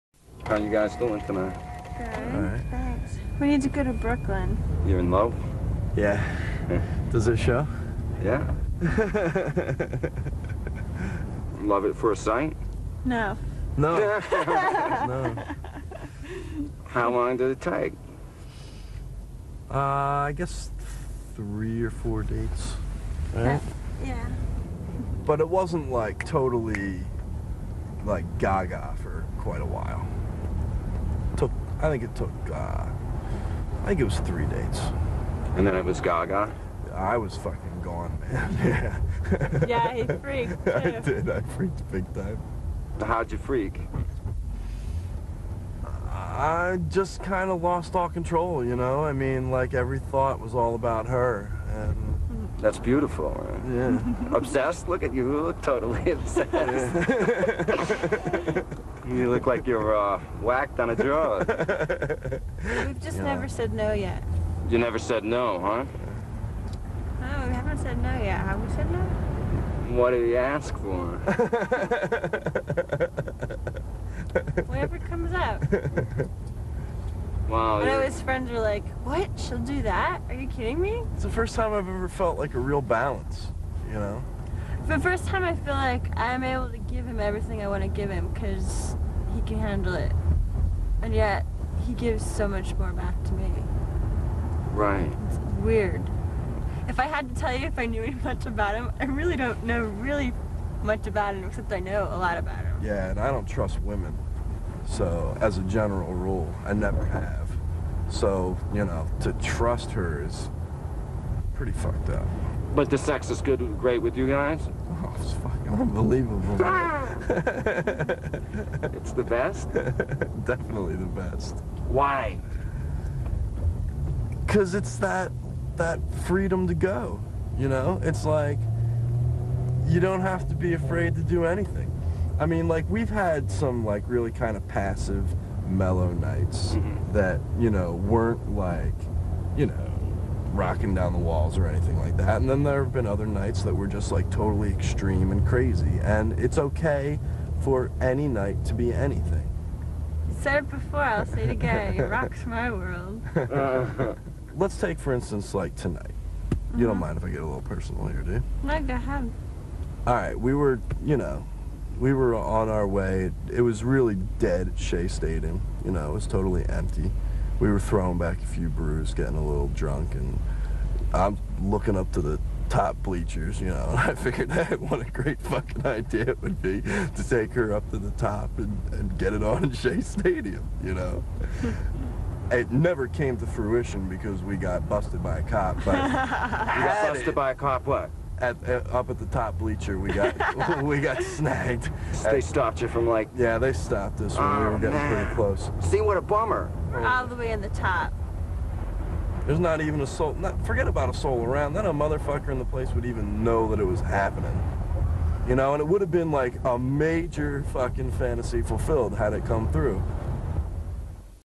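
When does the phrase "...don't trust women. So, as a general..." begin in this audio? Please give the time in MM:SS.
01:43.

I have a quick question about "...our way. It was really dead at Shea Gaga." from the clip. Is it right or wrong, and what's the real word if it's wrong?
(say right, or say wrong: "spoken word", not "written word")
wrong: "Stadium", not "Gaga".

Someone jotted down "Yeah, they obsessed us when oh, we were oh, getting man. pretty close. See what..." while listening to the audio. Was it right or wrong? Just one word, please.
wrong.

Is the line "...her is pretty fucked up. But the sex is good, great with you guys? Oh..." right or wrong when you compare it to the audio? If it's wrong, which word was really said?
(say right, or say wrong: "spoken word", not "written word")
right.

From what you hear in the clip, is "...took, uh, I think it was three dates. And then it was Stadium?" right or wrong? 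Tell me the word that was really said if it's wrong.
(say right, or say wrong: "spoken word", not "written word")
wrong: "Gaga", not "Stadium".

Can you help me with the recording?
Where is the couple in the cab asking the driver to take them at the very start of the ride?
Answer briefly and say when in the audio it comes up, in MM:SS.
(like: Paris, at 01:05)
Brooklyn, at 00:03.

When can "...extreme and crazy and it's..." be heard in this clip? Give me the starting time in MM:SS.
02:24.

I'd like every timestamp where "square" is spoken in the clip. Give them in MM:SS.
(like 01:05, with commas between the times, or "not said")
not said.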